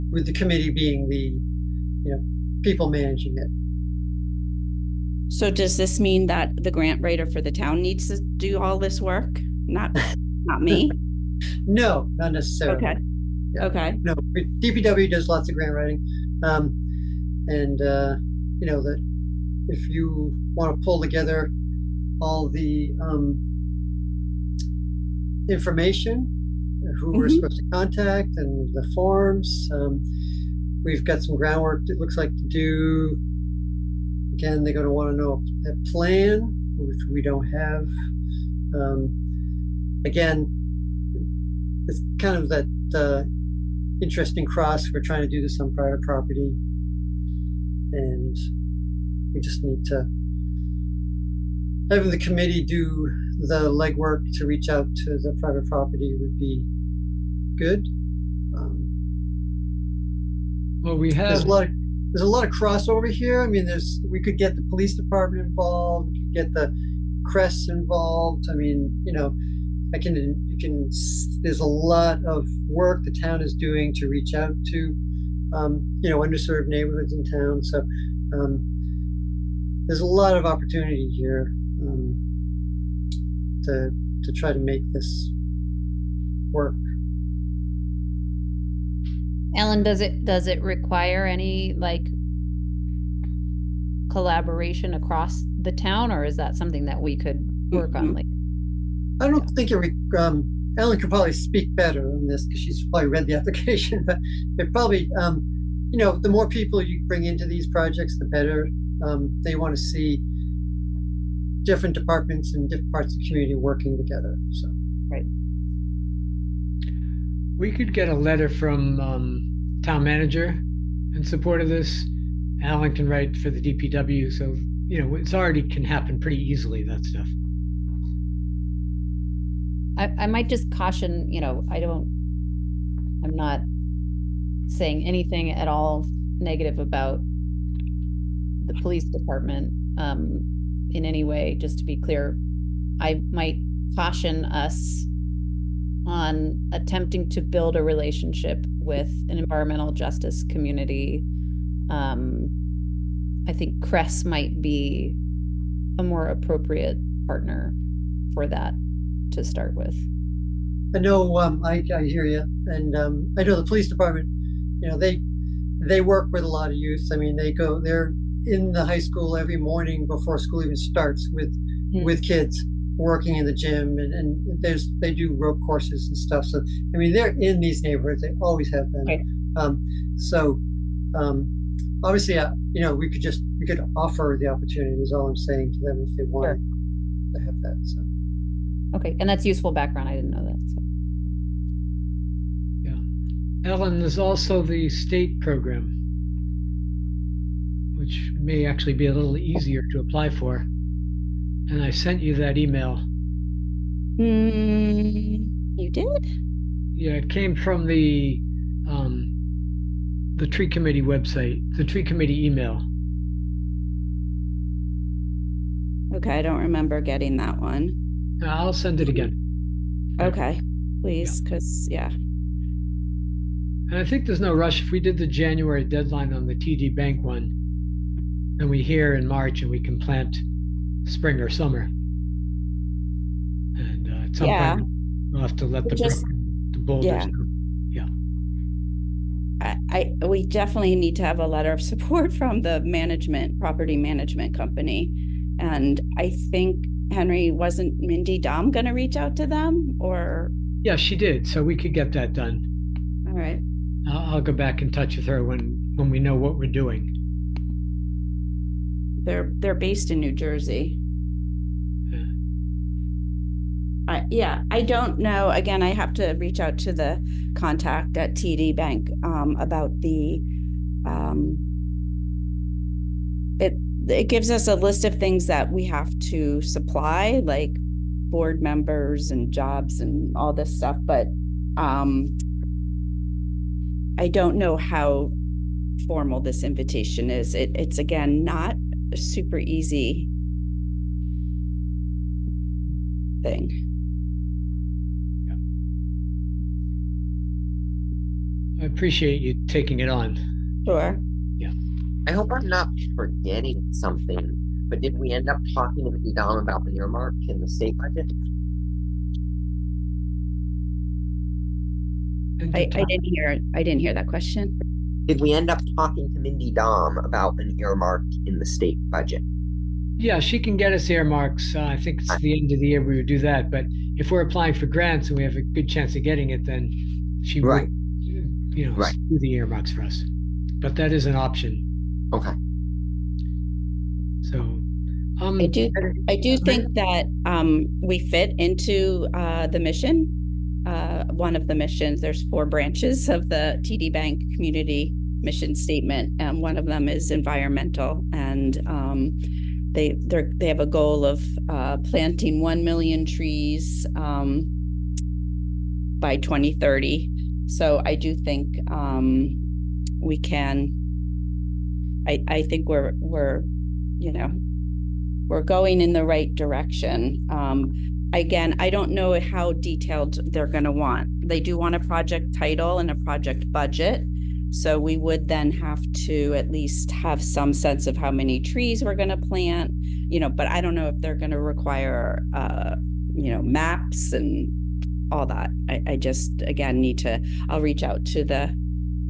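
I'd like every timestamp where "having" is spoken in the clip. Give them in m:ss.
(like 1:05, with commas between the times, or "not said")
0:51.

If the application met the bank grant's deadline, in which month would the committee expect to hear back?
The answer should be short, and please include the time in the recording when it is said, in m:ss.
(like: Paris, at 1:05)
March, at 3:49.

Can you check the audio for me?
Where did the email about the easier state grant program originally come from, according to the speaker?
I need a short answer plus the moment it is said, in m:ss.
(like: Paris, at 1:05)
The tree committee website, at 3:30.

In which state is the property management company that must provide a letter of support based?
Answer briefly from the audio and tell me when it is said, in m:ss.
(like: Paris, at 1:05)
New Jersey, at 4:20.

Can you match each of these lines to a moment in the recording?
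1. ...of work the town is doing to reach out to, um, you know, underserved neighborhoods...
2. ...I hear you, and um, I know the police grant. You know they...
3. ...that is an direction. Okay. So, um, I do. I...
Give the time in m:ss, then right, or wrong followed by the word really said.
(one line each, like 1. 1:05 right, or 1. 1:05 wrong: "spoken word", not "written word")
1. 1:12 right
2. 2:41 wrong: "department", not "grant"
3. 5:30 wrong: "option", not "direction".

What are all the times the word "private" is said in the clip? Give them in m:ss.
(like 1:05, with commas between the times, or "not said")
0:45, 0:55.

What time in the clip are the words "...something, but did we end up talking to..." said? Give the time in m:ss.
5:03.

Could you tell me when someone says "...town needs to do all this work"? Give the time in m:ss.
0:07.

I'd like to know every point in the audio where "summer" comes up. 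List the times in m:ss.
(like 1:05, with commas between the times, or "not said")
3:51.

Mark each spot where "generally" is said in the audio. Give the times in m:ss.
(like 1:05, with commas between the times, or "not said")
not said.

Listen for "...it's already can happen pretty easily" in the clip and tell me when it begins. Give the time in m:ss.
2:05.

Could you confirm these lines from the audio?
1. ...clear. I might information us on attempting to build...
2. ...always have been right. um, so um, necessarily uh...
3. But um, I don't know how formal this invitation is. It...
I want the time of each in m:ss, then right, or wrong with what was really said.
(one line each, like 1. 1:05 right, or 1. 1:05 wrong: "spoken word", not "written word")
1. 2:21 wrong: "caution", not "information"
2. 2:58 wrong: "obviously", not "necessarily"
3. 4:41 right.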